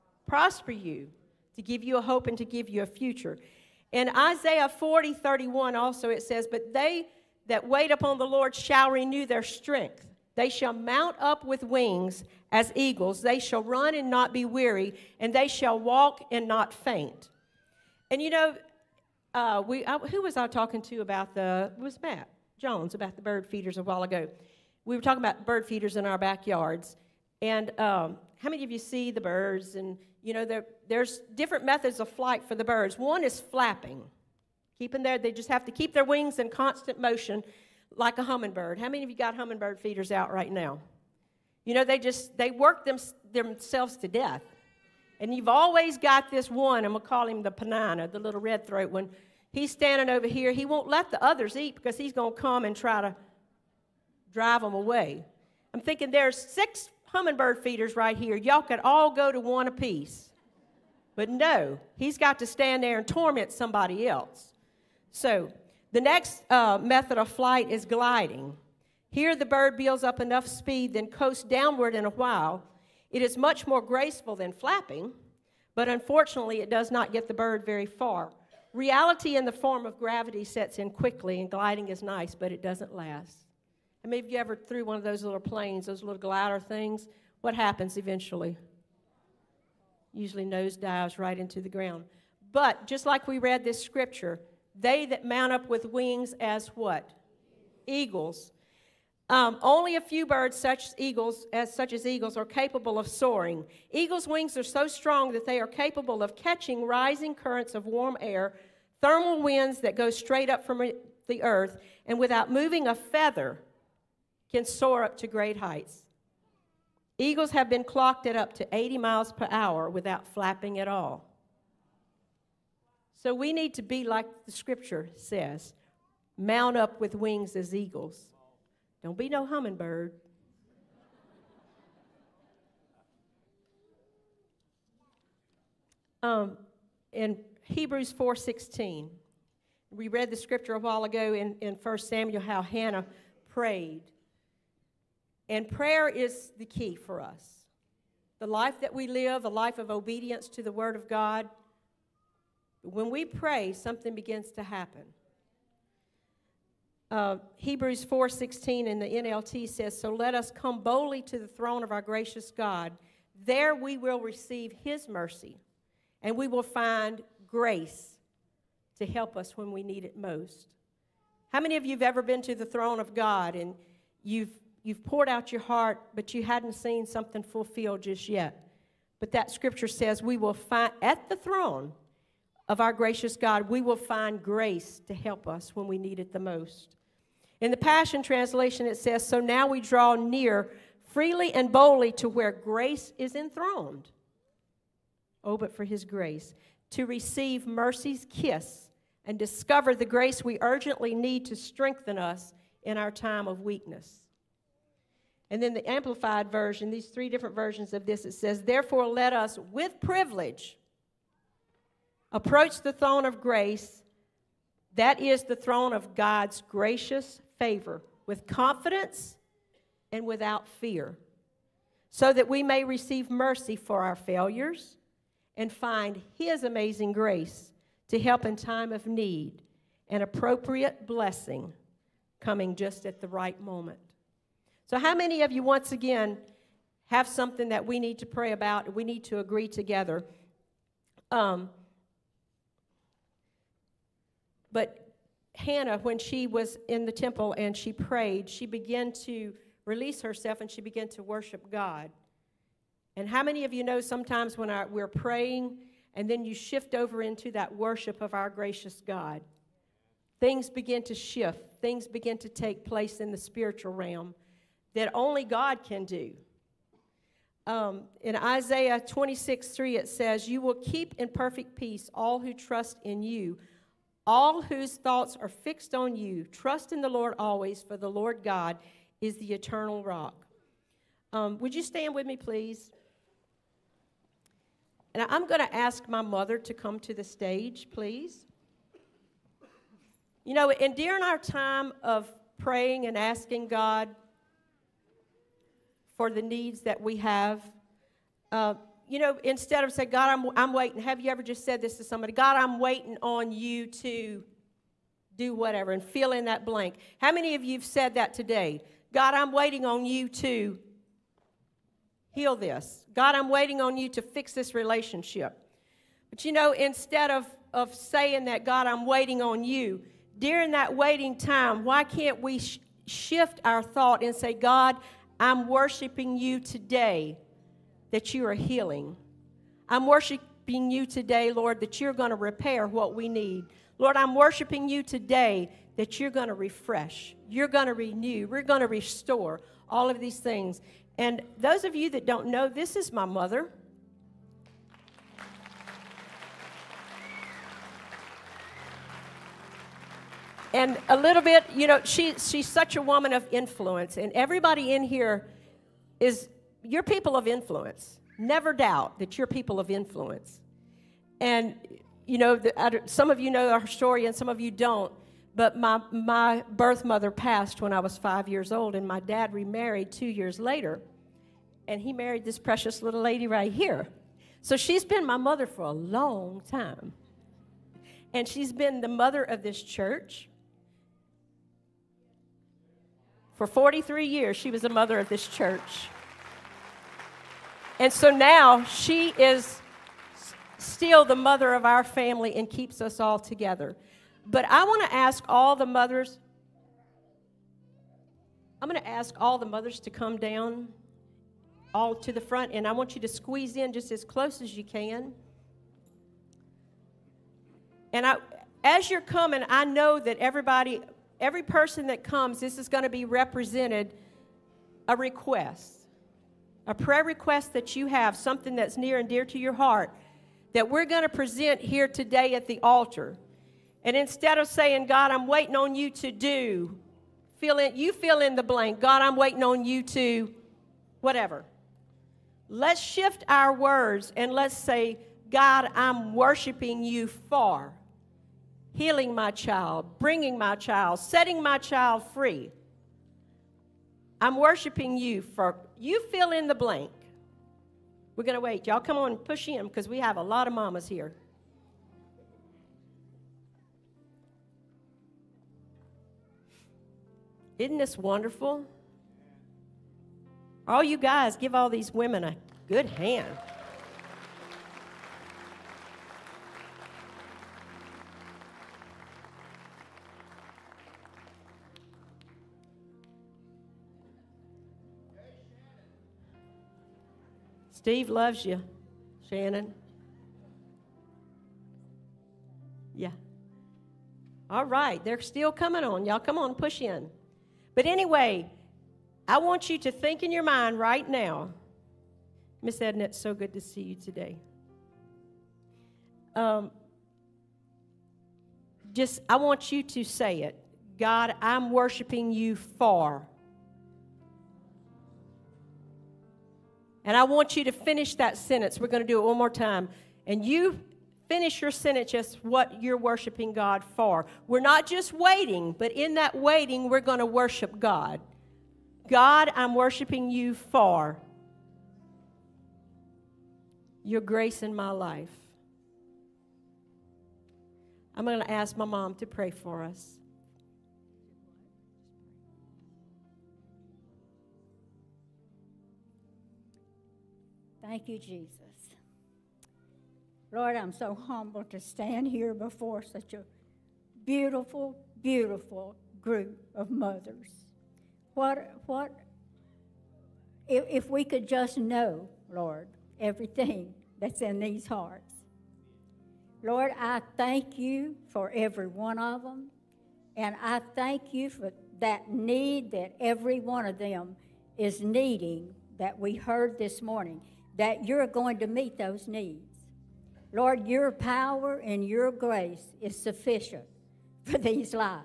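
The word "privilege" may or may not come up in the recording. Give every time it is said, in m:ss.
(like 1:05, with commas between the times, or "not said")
3:29.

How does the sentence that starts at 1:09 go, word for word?
Here the bird builds up enough speed, then coasts downward in a while.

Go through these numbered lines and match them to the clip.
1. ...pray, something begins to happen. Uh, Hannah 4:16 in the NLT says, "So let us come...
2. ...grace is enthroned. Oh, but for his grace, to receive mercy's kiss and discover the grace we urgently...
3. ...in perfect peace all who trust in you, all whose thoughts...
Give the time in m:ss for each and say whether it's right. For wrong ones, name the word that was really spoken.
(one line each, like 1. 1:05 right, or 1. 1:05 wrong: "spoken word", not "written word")
1. 2:33 wrong: "Hebrews", not "Hannah"
2. 3:12 right
3. 4:31 right.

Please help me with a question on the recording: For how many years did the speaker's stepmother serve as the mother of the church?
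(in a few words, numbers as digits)
43.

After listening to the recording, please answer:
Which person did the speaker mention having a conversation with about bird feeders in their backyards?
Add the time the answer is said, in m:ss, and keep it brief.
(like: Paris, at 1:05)
Matt Jones, at 0:22.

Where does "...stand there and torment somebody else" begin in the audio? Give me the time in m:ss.
1:02.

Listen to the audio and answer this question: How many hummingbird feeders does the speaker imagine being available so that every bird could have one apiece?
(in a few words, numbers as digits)
6.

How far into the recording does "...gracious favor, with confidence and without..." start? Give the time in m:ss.
3:36.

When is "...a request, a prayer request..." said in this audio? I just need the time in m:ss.
6:55.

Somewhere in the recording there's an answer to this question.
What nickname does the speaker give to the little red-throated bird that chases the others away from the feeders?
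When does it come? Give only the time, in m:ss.
0:47.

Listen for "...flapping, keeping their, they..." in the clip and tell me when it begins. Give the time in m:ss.
0:33.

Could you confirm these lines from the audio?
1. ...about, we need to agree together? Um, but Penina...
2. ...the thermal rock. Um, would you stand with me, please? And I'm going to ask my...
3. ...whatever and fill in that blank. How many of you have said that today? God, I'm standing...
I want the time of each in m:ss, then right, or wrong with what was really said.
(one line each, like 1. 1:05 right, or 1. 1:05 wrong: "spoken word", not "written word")
1. 3:58 wrong: "Hannah", not "Penina"
2. 4:39 wrong: "eternal", not "thermal"
3. 5:05 wrong: "waiting", not "standing".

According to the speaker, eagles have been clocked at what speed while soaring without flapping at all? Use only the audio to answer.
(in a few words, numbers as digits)
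80 miles per hour.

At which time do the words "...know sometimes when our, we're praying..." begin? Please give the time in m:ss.
4:13.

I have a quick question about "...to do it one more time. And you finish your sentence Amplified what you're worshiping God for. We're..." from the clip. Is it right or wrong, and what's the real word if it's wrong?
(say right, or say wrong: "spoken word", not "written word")
wrong: "Just", not "Amplified".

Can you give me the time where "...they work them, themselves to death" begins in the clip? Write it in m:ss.
0:42.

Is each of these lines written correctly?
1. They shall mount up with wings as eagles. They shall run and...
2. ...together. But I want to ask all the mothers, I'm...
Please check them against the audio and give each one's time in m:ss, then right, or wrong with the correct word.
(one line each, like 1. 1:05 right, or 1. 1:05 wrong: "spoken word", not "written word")
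1. 0:10 right
2. 6:33 right.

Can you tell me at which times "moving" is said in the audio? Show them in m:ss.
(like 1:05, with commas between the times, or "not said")
1:52.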